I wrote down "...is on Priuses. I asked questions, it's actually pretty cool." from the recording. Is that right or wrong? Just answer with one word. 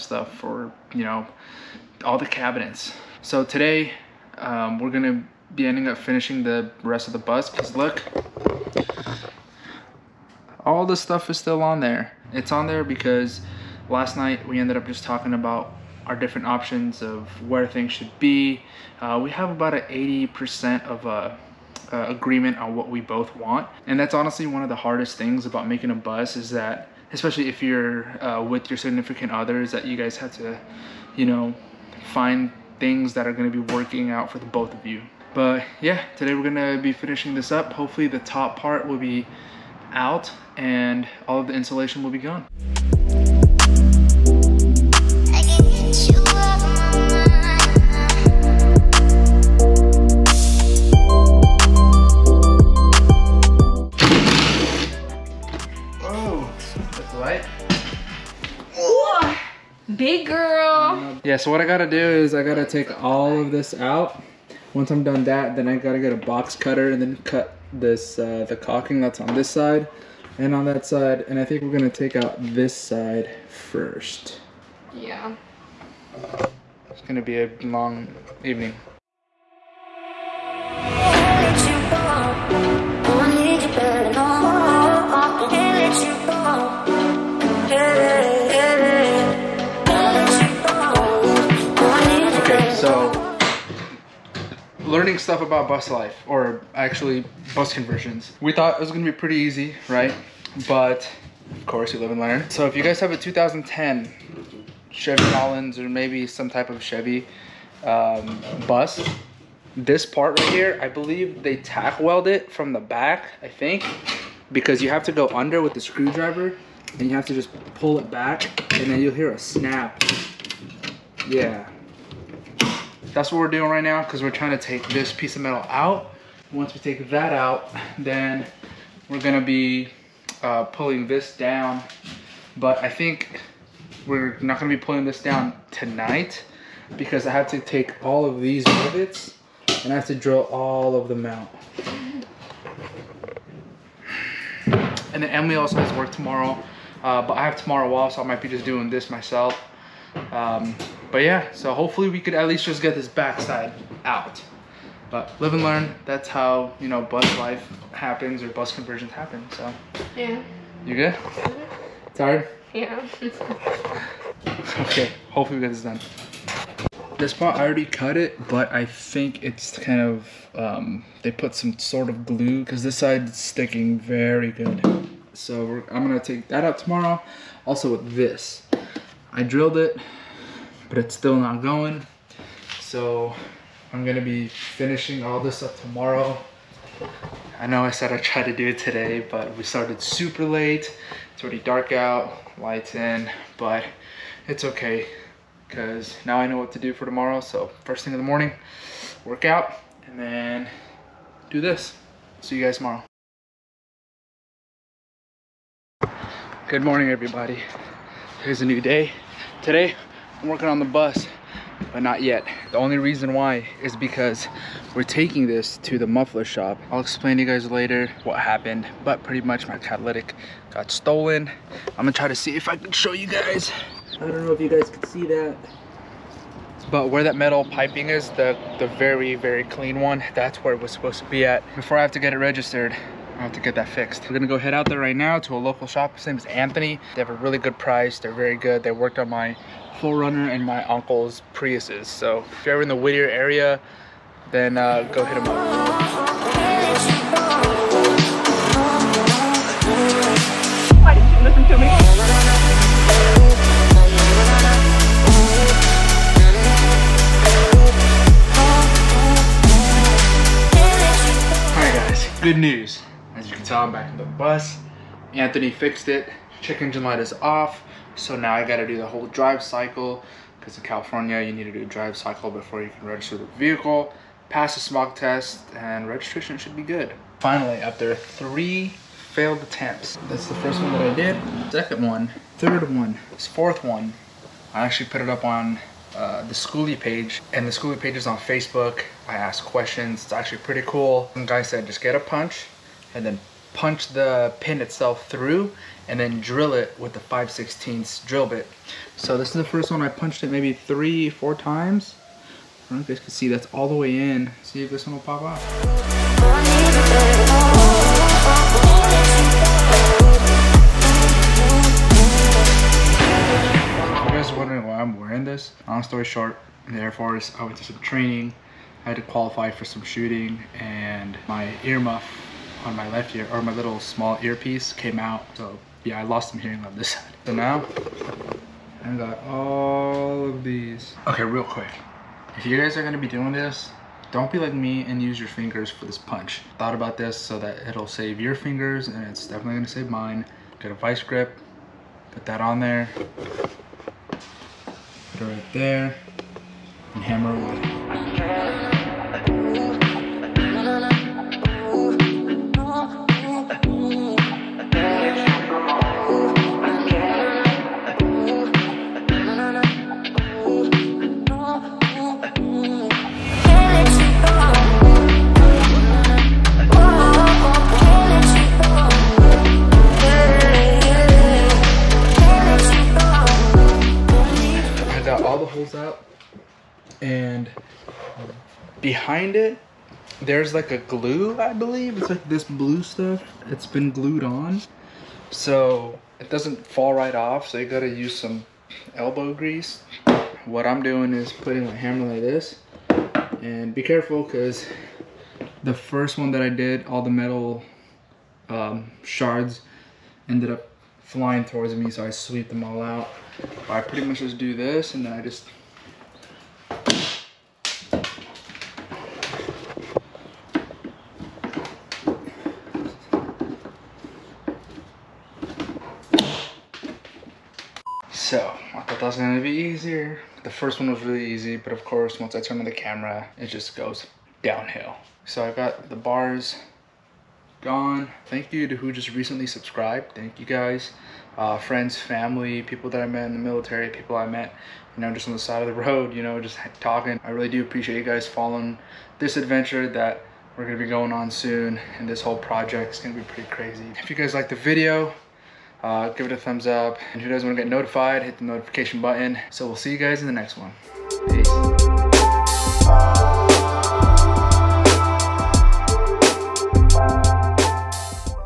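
wrong.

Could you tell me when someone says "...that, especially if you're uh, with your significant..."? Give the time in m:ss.
0:26.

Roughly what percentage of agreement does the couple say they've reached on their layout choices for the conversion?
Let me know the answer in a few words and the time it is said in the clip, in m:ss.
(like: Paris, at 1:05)
80%, at 0:19.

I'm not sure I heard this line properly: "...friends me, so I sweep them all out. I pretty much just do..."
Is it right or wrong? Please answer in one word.
wrong.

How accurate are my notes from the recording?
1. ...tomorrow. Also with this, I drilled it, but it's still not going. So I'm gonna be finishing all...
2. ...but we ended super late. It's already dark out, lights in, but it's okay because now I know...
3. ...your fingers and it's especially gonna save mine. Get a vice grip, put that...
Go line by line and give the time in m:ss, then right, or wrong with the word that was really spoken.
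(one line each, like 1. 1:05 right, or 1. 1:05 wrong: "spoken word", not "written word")
1. 2:56 right
2. 3:09 wrong: "started", not "ended"
3. 5:38 wrong: "definitely", not "especially".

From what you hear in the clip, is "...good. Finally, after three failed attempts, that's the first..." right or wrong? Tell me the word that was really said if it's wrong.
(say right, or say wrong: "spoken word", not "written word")
right.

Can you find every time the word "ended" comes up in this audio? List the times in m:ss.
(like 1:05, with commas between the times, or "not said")
0:14, 6:40.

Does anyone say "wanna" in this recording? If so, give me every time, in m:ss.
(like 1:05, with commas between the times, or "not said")
7:27.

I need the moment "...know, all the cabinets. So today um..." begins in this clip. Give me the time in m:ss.
0:01.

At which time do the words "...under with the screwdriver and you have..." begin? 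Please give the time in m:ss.
1:55.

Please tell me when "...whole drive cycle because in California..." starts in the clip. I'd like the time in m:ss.
4:29.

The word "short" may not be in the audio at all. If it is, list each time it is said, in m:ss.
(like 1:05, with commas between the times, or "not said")
5:16.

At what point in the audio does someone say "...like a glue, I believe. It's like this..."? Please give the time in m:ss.
6:20.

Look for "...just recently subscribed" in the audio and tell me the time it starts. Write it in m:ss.
7:09.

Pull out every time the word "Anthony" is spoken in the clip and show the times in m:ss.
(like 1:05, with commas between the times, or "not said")
3:56, 4:25.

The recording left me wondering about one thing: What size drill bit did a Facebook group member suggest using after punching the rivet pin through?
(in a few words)
5/16.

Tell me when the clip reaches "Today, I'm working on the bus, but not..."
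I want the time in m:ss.
3:29.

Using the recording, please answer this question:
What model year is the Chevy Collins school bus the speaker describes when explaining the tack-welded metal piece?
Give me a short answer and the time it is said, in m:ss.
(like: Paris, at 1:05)
2010, at 1:43.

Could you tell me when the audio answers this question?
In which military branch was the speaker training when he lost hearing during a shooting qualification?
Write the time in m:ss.
5:17.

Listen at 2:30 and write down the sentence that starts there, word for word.
Um, but yeah, so hopefully we could at least just get this backside out.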